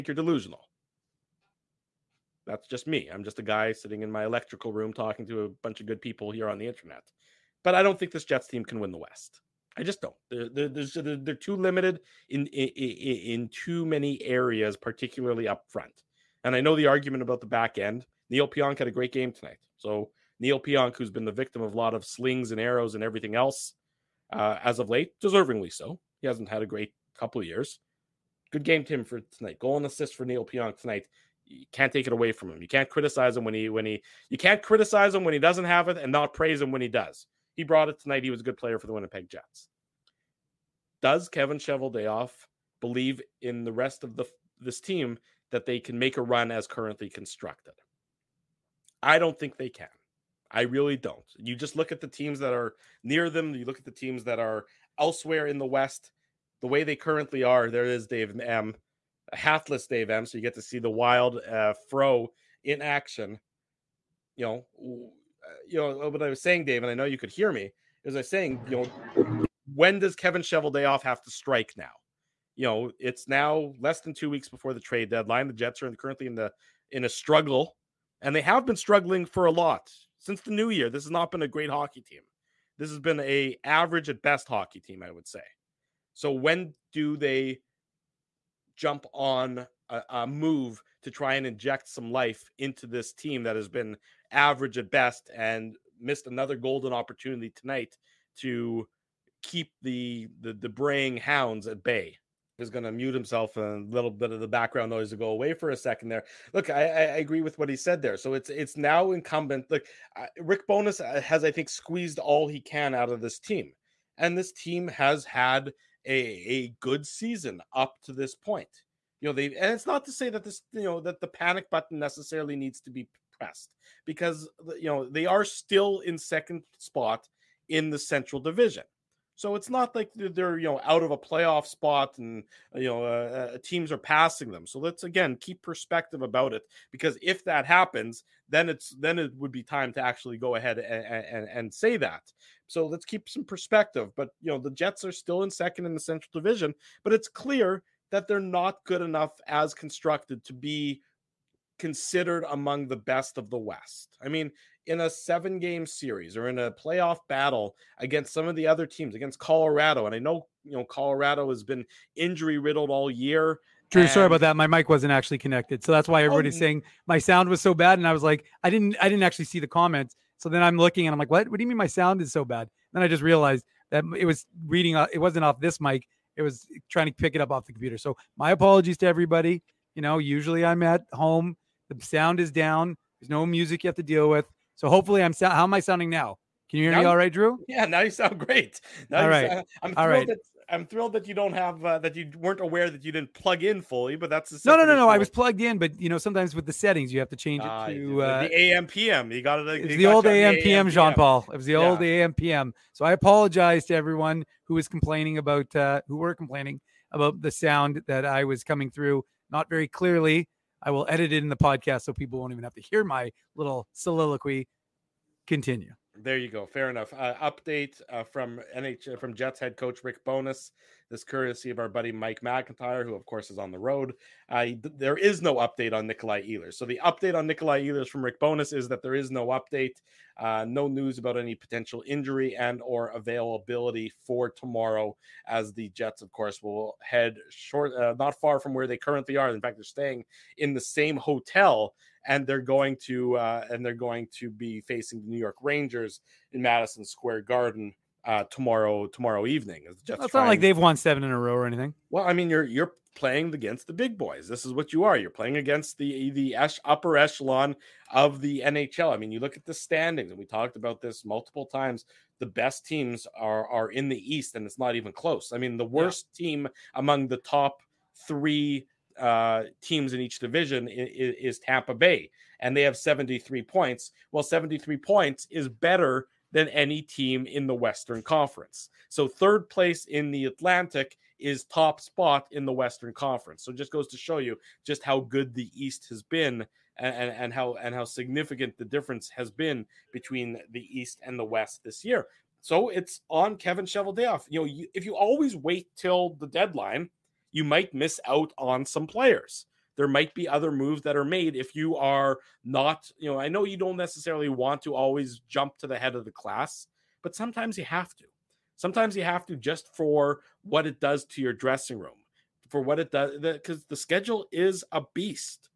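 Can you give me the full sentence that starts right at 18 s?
Neil Pionk had a great game tonight.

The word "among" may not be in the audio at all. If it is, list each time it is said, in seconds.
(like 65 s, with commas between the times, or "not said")
152 s, 266 s.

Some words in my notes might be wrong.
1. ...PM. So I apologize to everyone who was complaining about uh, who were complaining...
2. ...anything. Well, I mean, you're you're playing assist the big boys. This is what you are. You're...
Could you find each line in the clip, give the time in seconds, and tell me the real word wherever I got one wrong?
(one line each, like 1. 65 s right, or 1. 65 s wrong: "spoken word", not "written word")
1. 202 s right
2. 251 s wrong: "against", not "assist".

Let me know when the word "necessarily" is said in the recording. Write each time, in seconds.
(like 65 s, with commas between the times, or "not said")
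121 s, 303 s.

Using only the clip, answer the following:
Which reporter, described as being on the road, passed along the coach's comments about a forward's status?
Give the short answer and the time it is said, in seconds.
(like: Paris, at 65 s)
Mike McIntyre, at 222 s.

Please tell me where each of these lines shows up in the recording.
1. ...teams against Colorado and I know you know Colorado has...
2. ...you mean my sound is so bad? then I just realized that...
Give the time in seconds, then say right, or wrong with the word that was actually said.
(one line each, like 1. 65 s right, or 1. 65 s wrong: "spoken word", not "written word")
1. 158 s right
2. 171 s right.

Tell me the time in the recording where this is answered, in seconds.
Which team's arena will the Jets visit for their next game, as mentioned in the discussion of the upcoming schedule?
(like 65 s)
245 s.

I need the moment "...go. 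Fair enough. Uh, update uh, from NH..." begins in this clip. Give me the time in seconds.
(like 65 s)
216 s.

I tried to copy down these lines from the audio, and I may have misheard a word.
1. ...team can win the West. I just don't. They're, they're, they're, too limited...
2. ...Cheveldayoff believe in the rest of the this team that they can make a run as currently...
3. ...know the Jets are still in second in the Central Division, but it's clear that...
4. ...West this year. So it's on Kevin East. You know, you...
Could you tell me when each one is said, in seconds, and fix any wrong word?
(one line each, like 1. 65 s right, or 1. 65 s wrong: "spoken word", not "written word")
1. 8 s right
2. 41 s right
3. 144 s right
4. 291 s wrong: "Cheveldayoff", not "East".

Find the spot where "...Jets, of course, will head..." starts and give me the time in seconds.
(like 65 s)
235 s.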